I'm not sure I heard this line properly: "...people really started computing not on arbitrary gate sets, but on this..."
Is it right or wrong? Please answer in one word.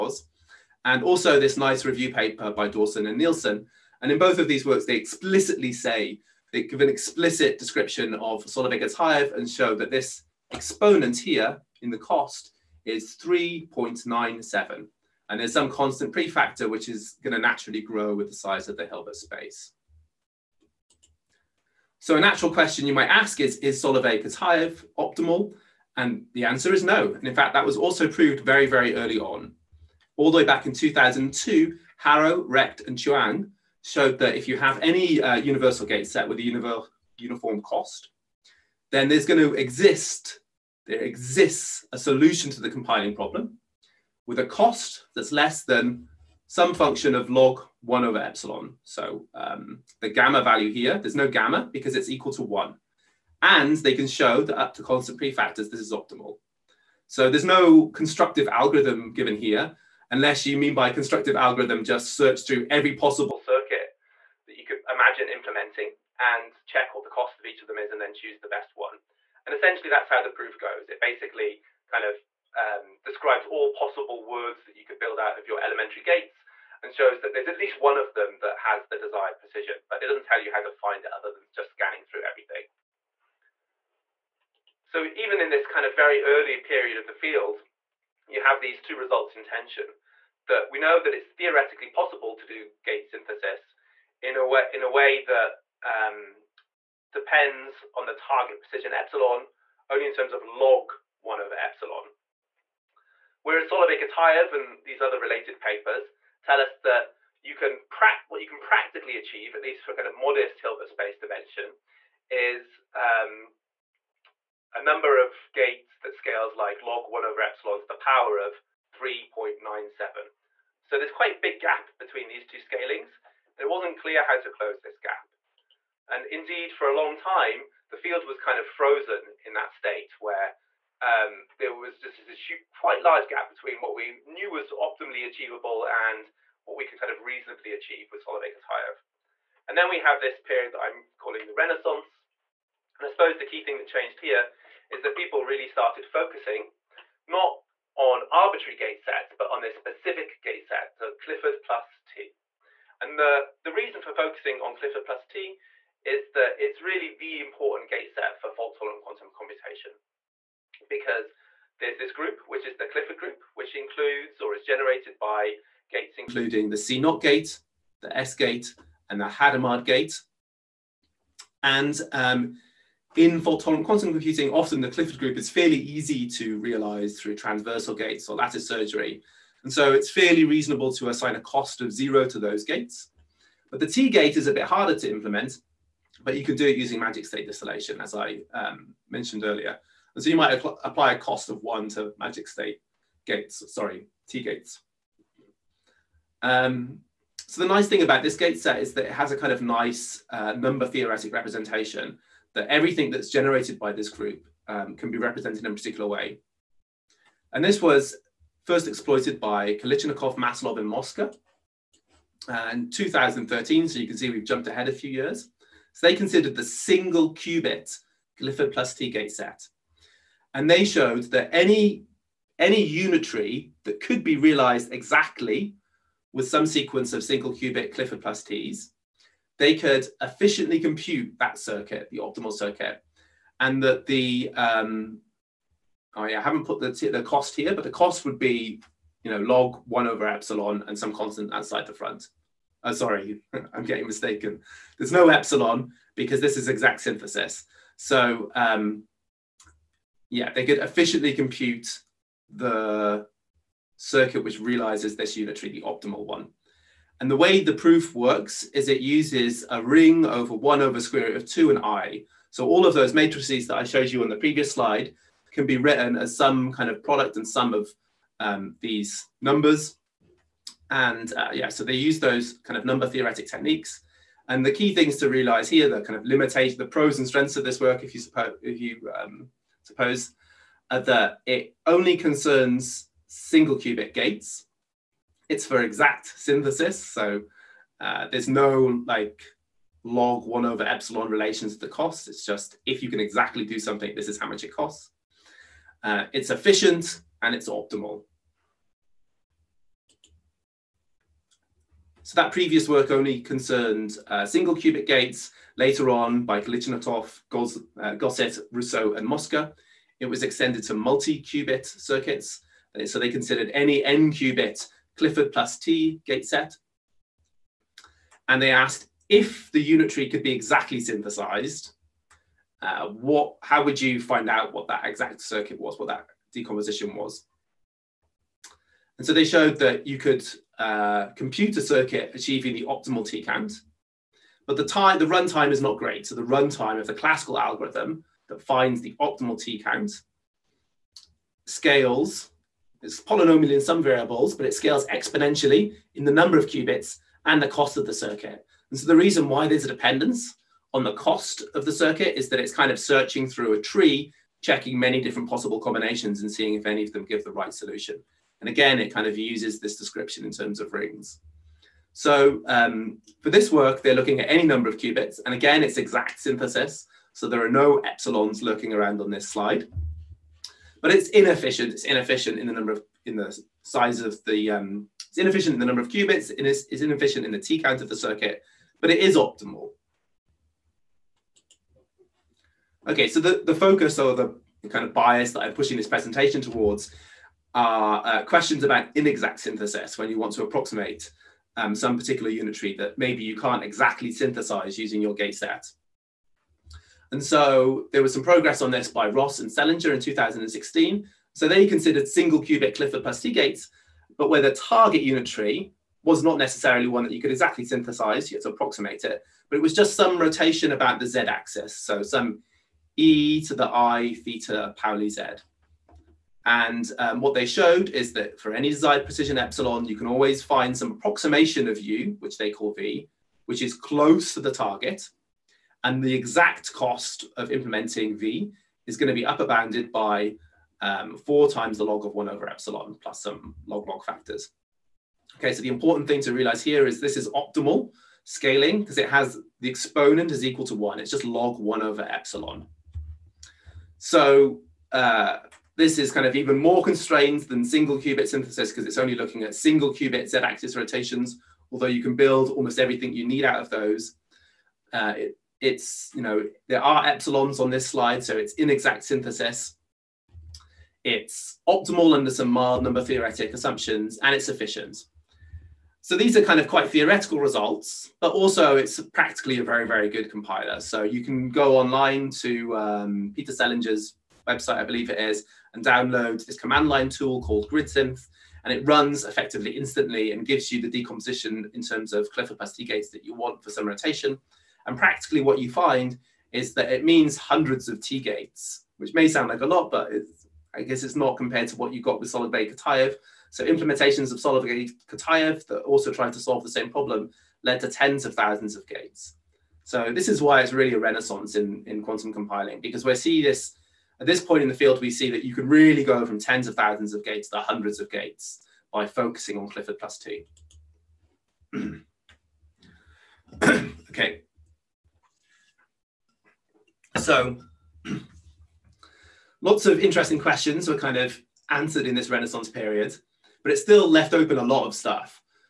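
wrong.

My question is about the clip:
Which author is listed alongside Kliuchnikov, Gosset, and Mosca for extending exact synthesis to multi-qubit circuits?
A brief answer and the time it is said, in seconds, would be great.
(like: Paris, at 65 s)
Russo, at 308 s.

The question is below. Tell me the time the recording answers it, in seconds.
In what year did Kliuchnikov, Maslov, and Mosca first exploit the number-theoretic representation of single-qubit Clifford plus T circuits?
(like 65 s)
212 s.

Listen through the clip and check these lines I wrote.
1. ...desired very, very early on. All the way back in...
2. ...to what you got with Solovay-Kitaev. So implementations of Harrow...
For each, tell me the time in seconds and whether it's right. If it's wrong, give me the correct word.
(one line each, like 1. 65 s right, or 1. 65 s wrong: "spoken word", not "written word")
1. 28 s wrong: "proved", not "desired"
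2. 491 s wrong: "Solid", not "Harrow".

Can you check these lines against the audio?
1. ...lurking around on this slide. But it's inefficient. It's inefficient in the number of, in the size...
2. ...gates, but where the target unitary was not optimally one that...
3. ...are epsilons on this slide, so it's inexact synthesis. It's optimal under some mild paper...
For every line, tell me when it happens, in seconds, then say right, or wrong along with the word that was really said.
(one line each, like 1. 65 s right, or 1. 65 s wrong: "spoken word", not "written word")
1. 368 s right
2. 403 s wrong: "necessarily", not "optimally"
3. 457 s wrong: "number", not "paper".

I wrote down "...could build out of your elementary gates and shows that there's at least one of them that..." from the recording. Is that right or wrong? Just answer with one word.
right.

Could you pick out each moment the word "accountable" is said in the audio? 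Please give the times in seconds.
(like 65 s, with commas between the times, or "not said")
not said.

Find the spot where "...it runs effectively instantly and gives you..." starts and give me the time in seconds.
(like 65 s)
478 s.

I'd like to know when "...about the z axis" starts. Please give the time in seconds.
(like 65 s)
410 s.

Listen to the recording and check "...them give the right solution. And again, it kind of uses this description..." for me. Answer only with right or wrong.
right.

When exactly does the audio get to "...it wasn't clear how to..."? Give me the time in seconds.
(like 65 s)
123 s.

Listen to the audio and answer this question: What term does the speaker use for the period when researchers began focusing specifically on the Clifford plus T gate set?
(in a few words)
the Renaissance.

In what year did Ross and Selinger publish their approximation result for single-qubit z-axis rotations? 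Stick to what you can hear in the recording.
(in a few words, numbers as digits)
2016.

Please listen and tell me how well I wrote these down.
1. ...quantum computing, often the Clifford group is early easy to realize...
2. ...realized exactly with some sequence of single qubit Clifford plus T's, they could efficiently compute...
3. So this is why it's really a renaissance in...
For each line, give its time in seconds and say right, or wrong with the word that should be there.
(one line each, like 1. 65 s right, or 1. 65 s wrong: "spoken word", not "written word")
1. 173 s wrong: "fairly", not "early"
2. 224 s right
3. 500 s right.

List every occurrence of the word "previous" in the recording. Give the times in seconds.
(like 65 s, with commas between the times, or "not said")
264 s, 302 s.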